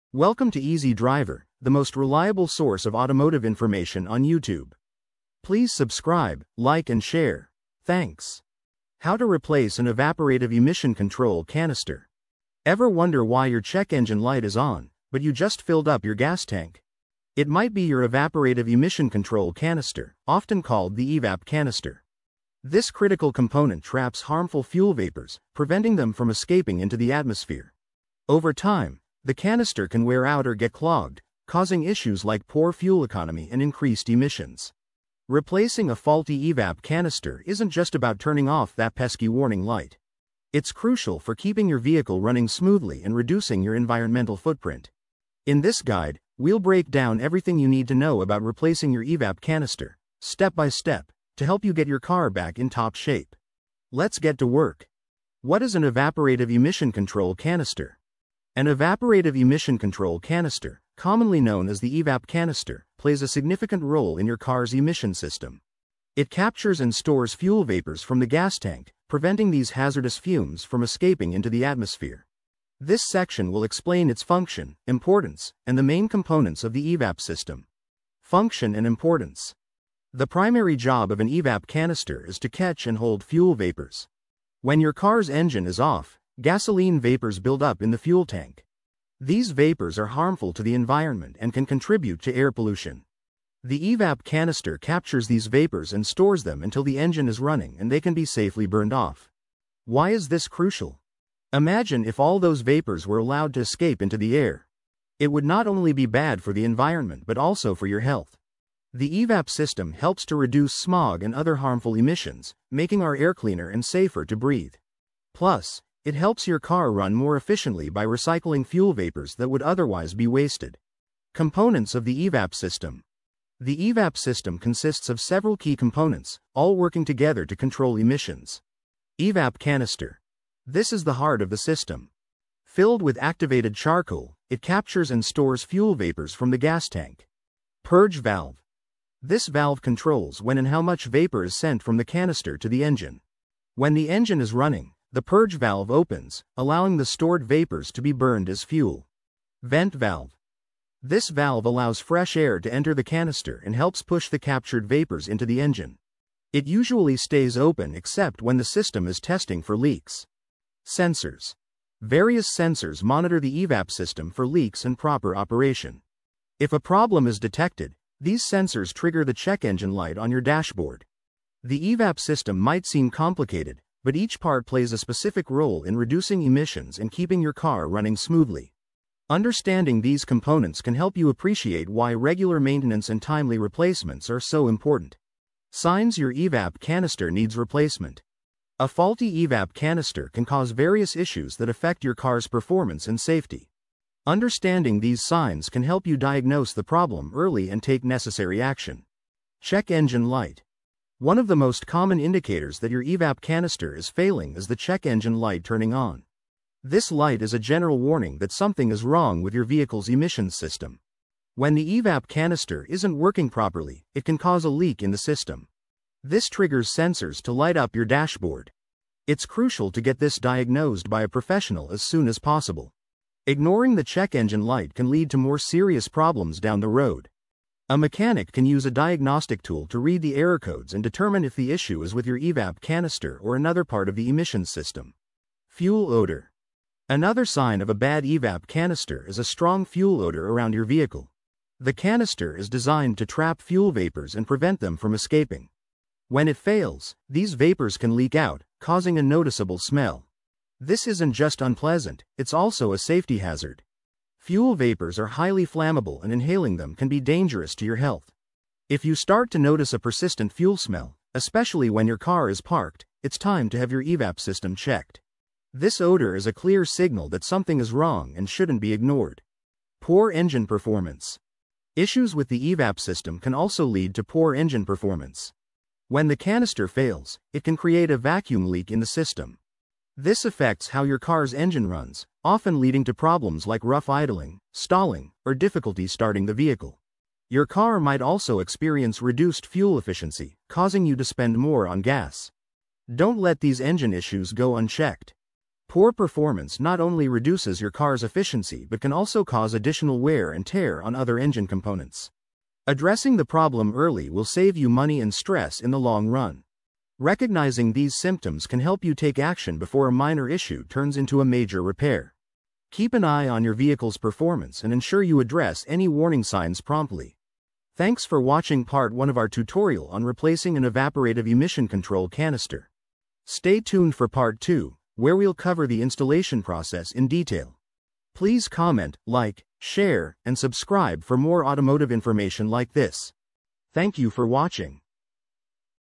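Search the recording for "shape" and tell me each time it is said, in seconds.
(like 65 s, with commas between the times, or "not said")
52 s.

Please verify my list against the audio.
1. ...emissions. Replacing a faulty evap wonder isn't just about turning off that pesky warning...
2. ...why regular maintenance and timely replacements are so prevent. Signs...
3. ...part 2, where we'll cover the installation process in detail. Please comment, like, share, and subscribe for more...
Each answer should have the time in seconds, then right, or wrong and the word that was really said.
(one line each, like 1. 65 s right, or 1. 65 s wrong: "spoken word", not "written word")
1. 34 s wrong: "canister", not "wonder"
2. 181 s wrong: "important", not "prevent"
3. 324 s right.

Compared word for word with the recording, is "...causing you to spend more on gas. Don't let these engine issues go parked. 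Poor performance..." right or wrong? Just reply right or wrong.
wrong.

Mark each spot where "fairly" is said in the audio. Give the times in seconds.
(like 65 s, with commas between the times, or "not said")
not said.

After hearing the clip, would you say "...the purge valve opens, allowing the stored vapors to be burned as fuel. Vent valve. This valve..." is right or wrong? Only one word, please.
right.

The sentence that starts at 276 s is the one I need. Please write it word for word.
When the canister fails, it can create a vacuum leak in the system.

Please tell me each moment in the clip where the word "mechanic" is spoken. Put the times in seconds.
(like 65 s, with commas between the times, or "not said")
227 s.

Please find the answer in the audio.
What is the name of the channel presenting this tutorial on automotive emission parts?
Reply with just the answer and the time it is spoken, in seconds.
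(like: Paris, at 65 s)
Easy Driver, at 0 s.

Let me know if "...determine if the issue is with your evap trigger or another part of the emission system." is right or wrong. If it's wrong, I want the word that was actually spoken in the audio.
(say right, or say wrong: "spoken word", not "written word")
wrong: "canister", not "trigger".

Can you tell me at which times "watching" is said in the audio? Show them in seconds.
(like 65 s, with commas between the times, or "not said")
318 s, 334 s.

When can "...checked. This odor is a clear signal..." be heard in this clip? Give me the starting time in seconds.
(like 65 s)
264 s.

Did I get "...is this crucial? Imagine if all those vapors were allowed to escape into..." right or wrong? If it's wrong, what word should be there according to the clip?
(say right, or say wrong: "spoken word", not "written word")
right.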